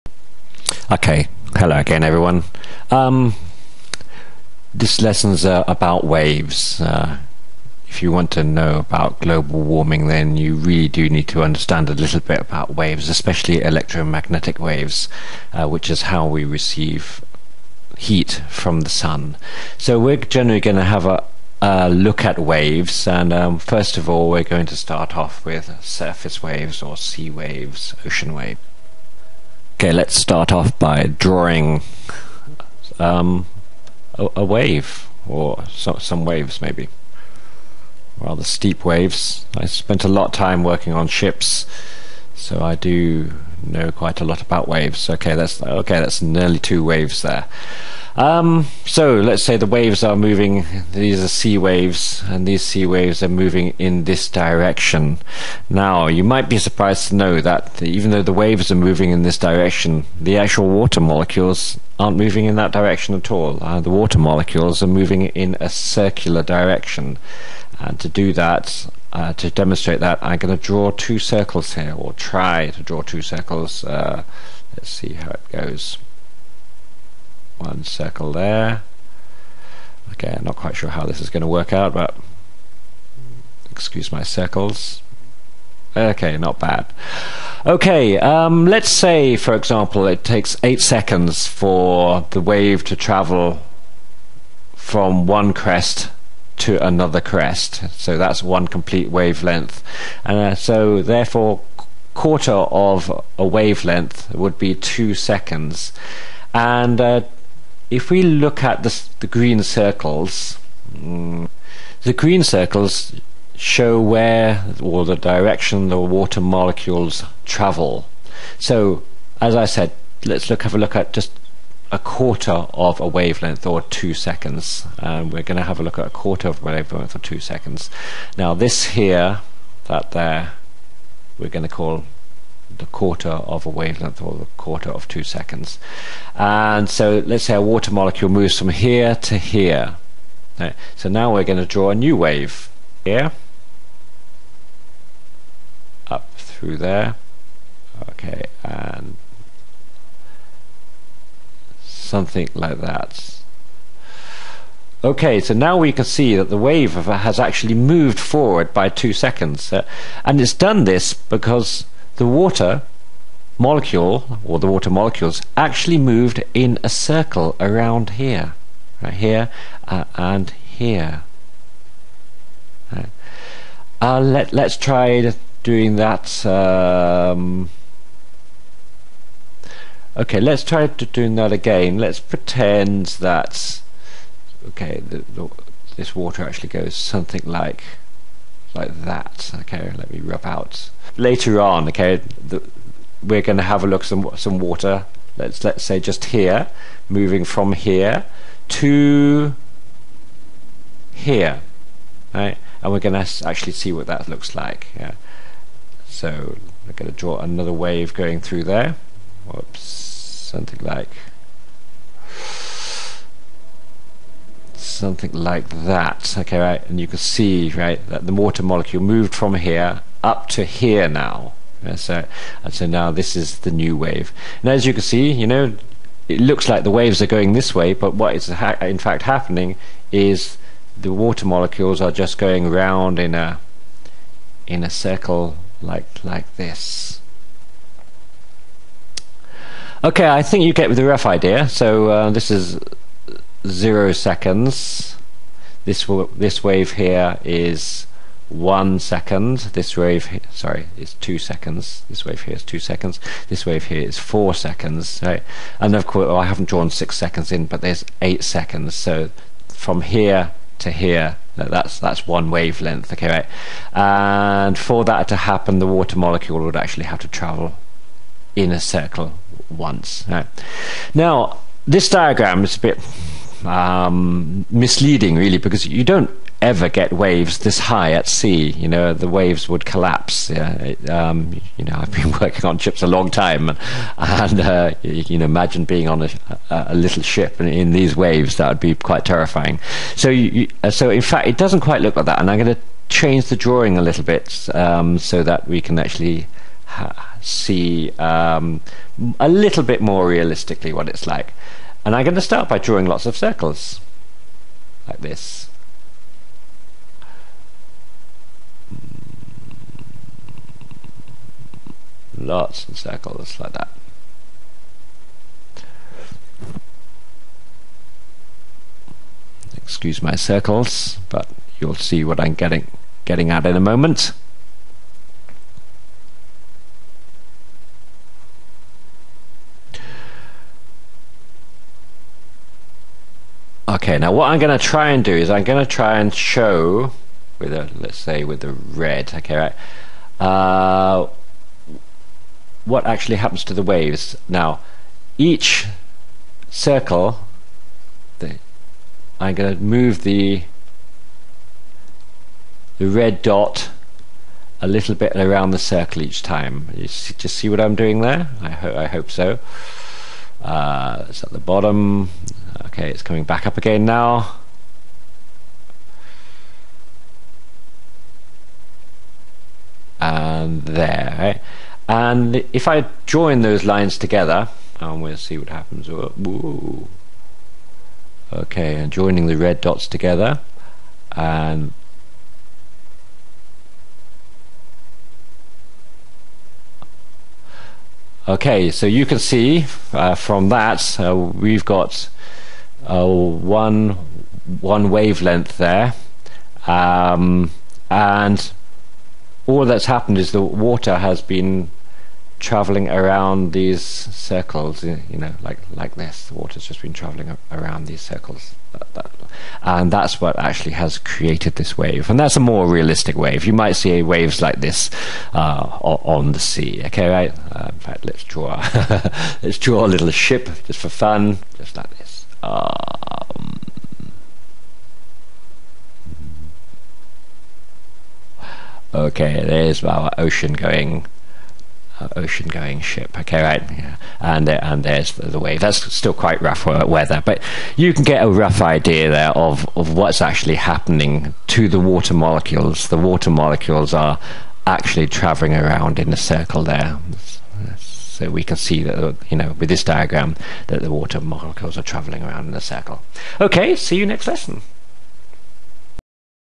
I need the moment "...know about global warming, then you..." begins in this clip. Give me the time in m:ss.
0:08.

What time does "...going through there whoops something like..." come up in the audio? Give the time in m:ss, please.
3:28.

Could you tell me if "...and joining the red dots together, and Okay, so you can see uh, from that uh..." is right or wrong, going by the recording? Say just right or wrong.
right.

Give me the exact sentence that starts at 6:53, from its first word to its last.
You might see waves like this uh, on the sea.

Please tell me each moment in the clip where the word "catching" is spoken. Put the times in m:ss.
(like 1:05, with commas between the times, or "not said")
not said.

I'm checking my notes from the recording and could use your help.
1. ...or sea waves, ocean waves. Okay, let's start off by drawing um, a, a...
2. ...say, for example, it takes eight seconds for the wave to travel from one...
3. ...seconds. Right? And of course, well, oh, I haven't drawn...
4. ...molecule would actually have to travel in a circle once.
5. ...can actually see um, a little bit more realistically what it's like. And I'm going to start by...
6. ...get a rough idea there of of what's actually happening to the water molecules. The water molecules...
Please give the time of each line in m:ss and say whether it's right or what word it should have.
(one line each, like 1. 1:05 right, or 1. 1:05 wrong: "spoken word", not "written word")
1. 0:26 right
2. 1:28 right
3. 4:14 right
4. 4:26 right
5. 4:55 right
6. 7:18 right.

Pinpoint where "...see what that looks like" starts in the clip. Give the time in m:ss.
3:23.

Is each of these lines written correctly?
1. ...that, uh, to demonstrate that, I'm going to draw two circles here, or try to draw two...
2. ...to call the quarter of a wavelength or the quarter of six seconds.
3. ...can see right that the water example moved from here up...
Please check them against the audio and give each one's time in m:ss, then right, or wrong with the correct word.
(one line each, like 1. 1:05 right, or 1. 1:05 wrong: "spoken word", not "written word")
1. 1:08 right
2. 2:11 wrong: "two", not "six"
3. 3:37 wrong: "molecule", not "example".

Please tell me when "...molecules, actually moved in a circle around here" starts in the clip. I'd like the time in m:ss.
2:44.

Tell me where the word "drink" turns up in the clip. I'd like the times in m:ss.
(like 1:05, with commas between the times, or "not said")
not said.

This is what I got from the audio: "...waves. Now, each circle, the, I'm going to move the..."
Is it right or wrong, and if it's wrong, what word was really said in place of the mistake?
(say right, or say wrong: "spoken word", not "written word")
right.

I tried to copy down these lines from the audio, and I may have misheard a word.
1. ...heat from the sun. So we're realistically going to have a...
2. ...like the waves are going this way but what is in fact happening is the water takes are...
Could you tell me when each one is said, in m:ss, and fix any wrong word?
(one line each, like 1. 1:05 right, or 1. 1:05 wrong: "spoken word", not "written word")
1. 0:17 wrong: "generally", not "realistically"
2. 3:46 wrong: "molecules", not "takes".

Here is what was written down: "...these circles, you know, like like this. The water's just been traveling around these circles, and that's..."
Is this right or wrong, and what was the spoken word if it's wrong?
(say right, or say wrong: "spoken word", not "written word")
right.